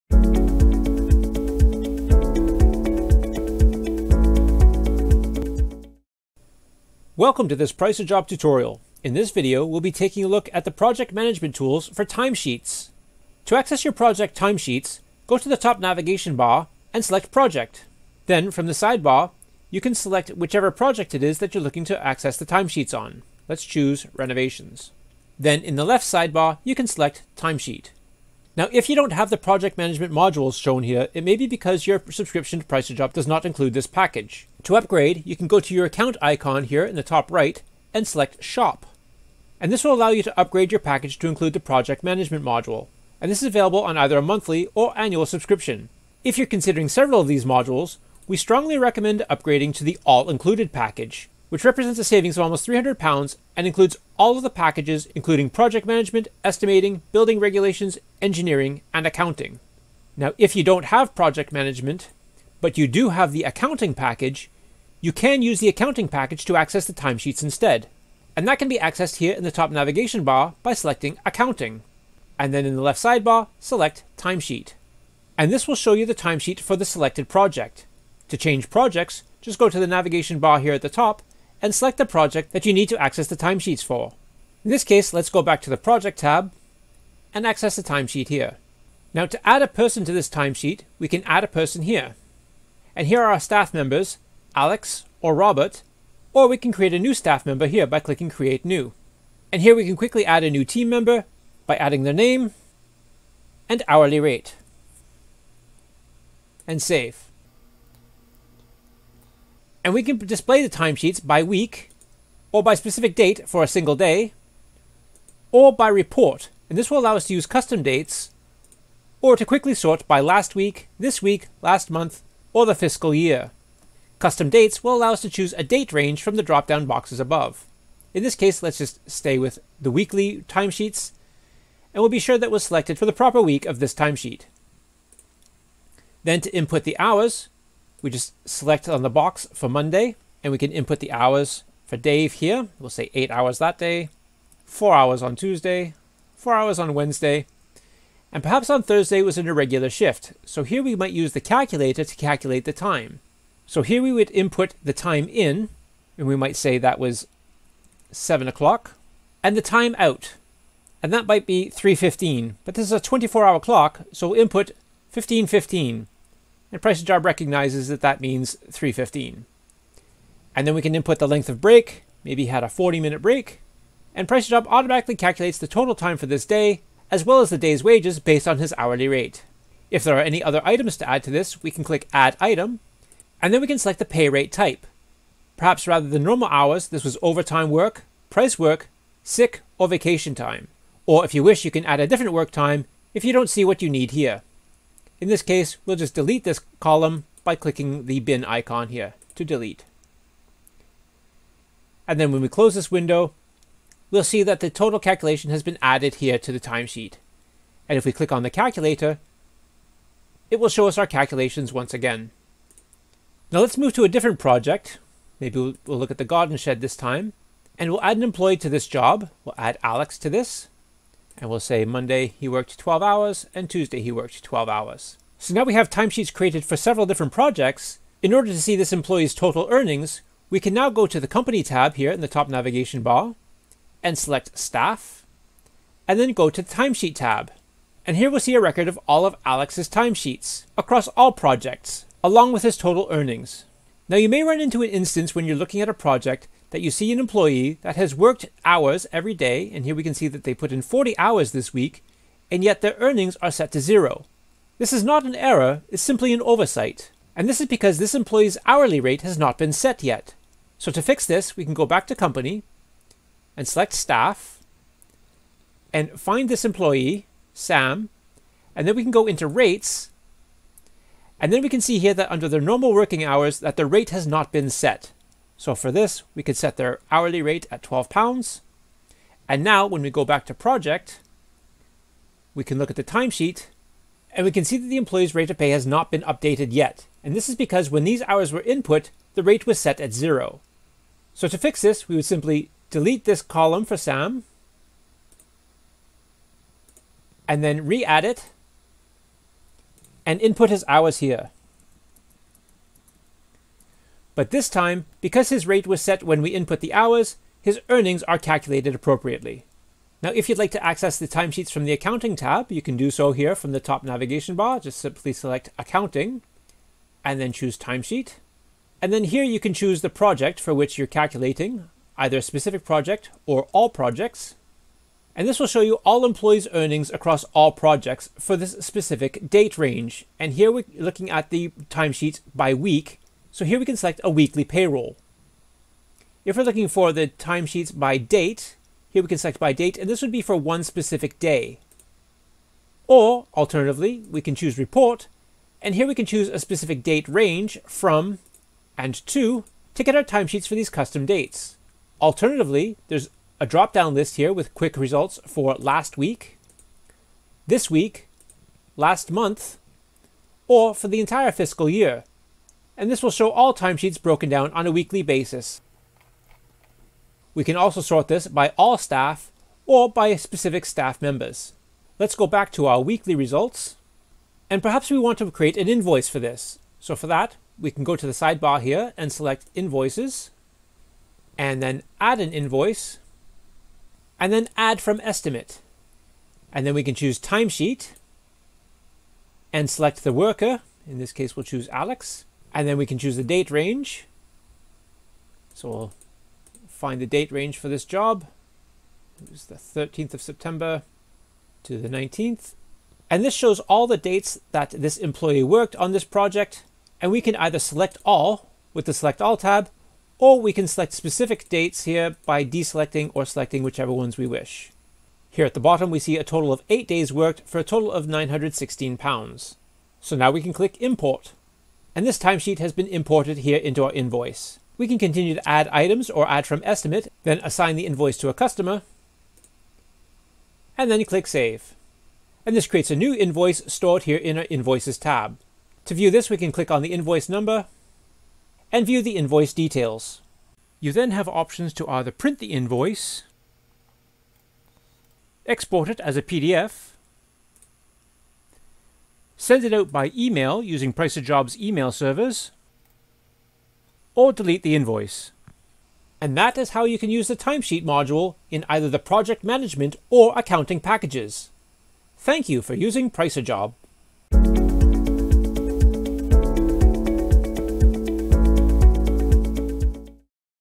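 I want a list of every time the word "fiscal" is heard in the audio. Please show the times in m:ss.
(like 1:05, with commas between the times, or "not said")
2:02, 6:01.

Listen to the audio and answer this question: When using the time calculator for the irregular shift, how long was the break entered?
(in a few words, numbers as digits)
40 minutes.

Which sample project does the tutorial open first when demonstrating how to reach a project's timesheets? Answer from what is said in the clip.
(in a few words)
Renovations.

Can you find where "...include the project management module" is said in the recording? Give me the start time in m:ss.
0:41.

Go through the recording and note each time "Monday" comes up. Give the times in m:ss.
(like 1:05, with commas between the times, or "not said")
2:19, 3:41.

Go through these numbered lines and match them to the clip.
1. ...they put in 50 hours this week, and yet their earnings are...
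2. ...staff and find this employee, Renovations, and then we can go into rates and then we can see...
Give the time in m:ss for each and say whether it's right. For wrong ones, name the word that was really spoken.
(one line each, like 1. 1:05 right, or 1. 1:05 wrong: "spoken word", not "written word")
1. 4:10 wrong: "40", not "50"
2. 4:23 wrong: "Sam", not "Renovations".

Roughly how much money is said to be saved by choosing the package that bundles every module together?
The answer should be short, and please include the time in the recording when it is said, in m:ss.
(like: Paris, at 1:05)
almost 300 pounds, at 0:52.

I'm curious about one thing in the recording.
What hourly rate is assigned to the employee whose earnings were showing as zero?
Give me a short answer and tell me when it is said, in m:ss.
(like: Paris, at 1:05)
12 pounds, at 4:37.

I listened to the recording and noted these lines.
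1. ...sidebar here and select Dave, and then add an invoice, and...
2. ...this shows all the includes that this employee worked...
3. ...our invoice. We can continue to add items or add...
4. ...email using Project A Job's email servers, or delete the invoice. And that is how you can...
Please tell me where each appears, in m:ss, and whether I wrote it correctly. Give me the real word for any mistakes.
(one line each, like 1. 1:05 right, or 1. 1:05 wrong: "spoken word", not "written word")
1. 6:18 wrong: "Invoices", not "Dave"
2. 6:43 wrong: "dates", not "includes"
3. 7:04 right
4. 7:30 wrong: "Price", not "Project".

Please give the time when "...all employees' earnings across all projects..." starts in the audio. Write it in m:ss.
5:26.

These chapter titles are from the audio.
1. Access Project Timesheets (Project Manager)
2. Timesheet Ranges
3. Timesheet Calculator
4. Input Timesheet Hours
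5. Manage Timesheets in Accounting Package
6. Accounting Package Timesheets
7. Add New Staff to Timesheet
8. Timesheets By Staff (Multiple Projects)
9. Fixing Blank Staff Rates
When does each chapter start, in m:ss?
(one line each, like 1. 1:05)
1. 1:25
2. 1:50
3. 2:30
4. 2:20
5. 5:15
6. 1:10
7. 1:40
8. 3:30
9. 4:20.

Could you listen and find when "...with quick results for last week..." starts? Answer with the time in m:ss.
5:54.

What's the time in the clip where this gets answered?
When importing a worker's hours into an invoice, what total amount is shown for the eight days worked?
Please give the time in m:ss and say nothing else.
6:58.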